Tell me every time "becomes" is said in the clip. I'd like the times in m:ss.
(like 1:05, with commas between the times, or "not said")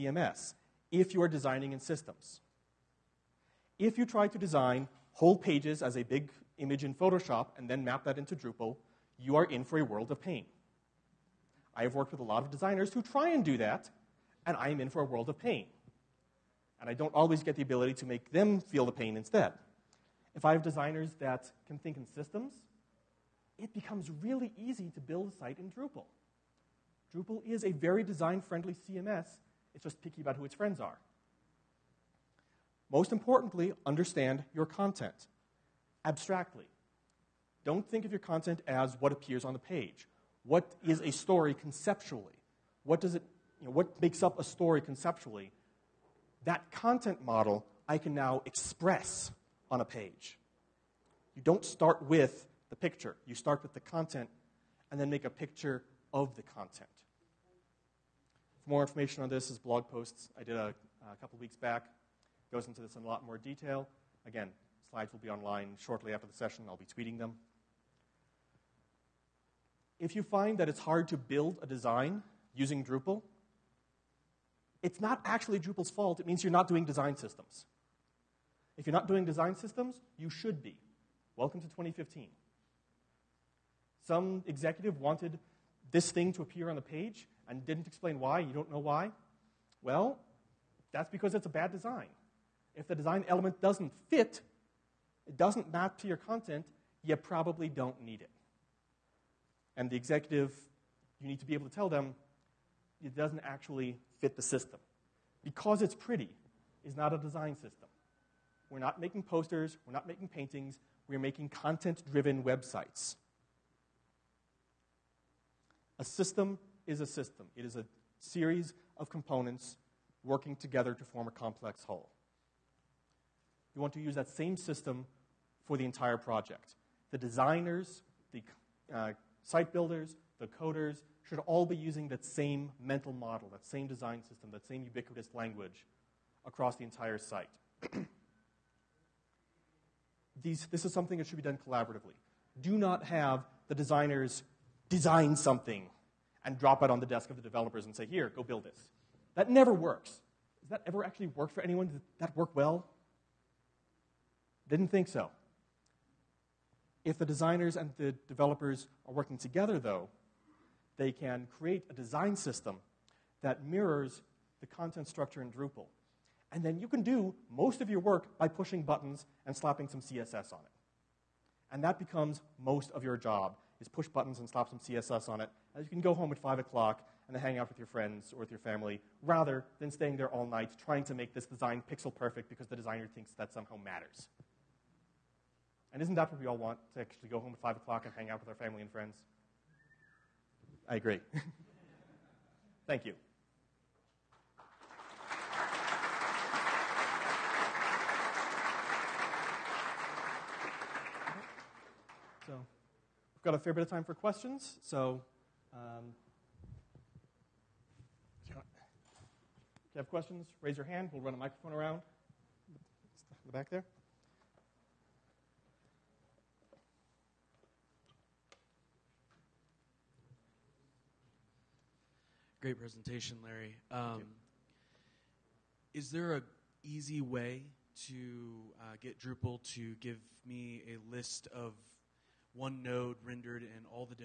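0:23, 2:51.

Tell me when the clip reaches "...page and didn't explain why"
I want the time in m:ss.
1:26.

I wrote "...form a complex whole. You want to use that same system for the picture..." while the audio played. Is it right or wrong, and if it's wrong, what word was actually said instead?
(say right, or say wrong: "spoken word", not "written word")
wrong: "entire", not "picture".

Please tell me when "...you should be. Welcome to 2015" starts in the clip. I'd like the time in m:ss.
1:20.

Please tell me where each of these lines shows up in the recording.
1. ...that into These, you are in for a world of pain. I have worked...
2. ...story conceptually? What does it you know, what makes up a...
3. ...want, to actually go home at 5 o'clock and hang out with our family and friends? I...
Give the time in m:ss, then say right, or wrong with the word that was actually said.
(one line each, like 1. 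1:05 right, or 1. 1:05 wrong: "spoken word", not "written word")
1. 0:08 wrong: "Drupal", not "These"
2. 0:41 right
3. 3:06 right.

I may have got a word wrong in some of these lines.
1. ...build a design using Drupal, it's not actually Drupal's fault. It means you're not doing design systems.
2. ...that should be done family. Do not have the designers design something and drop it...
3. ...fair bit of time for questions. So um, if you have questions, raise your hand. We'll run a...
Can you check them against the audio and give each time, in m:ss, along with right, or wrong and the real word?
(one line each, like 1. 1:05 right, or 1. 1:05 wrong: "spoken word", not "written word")
1. 1:11 right
2. 2:21 wrong: "collaboratively", not "family"
3. 3:23 right.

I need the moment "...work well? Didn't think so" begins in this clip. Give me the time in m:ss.
2:32.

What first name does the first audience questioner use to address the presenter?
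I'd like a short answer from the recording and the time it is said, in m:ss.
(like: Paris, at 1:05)
Larry, at 3:43.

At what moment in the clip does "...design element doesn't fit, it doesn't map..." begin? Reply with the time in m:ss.
1:32.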